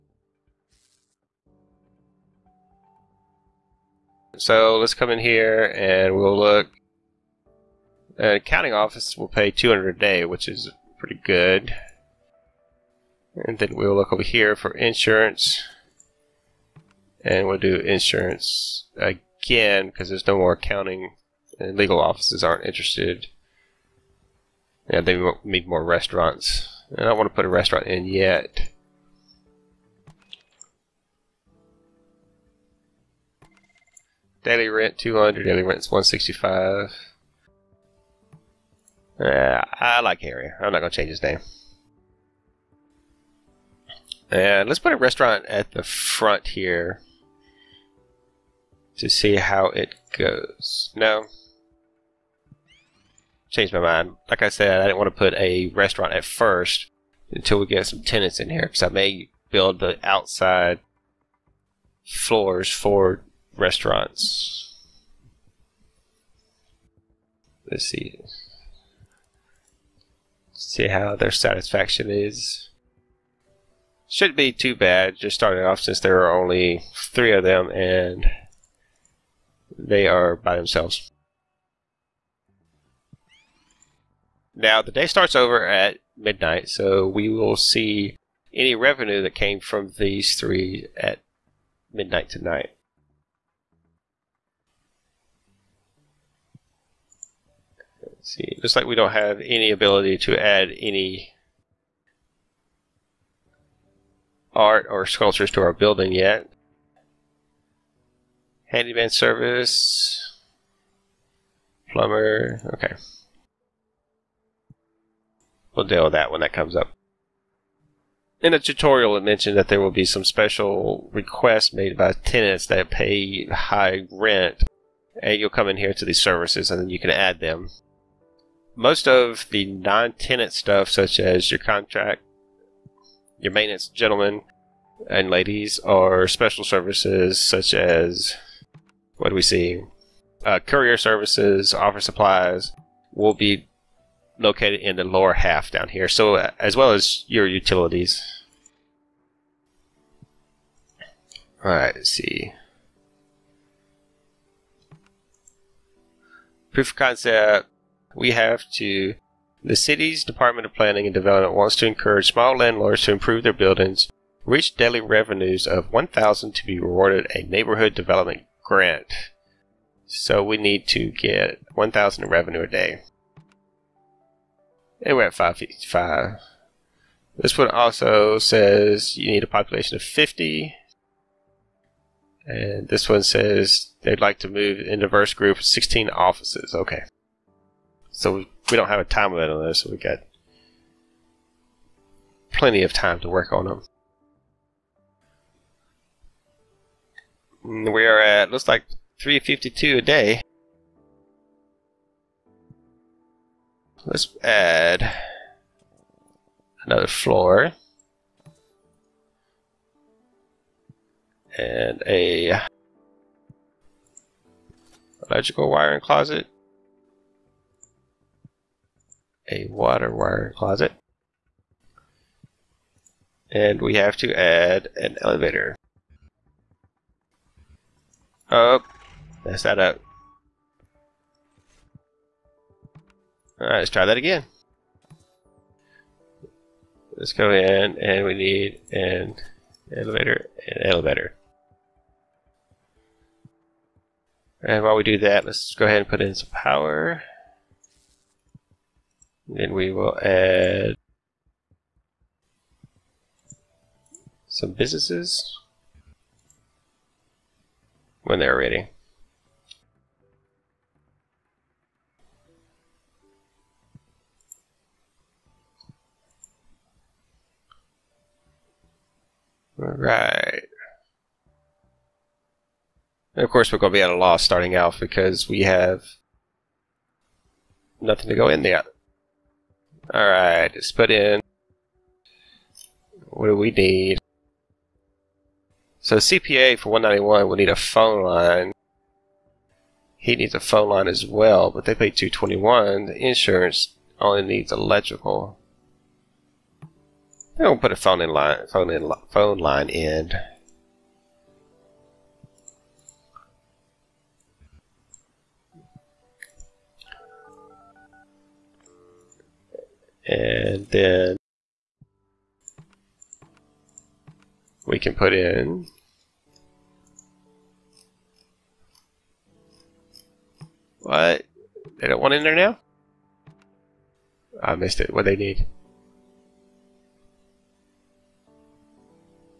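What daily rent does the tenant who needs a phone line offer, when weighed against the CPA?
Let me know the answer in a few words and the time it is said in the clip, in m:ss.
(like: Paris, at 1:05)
221, at 4:52.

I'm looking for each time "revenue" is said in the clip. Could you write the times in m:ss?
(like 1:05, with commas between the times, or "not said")
1:28, 2:44, 2:52.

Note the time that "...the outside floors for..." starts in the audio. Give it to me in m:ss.
0:59.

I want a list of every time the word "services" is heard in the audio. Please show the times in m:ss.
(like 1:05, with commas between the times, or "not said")
1:49, 2:06, 2:16, 2:20.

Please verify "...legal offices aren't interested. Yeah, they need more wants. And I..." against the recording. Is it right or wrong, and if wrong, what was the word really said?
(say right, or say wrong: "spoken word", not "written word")
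wrong: "restaurants", not "wants".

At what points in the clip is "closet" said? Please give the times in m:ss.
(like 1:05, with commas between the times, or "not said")
3:35, 3:40.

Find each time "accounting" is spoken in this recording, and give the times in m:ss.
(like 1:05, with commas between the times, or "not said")
0:08, 0:20.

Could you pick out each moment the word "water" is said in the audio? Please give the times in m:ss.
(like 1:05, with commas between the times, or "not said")
3:39.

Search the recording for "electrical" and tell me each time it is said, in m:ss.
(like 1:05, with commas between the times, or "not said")
3:35, 4:54.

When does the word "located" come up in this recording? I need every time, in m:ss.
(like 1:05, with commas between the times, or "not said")
2:24.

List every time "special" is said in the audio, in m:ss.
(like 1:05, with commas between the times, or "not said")
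2:00, 2:16.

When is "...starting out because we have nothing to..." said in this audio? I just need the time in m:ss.
4:34.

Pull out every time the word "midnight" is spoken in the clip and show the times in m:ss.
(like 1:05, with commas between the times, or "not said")
1:26, 1:31.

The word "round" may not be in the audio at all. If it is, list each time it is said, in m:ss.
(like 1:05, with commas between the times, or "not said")
not said.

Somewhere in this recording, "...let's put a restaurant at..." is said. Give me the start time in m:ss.
0:44.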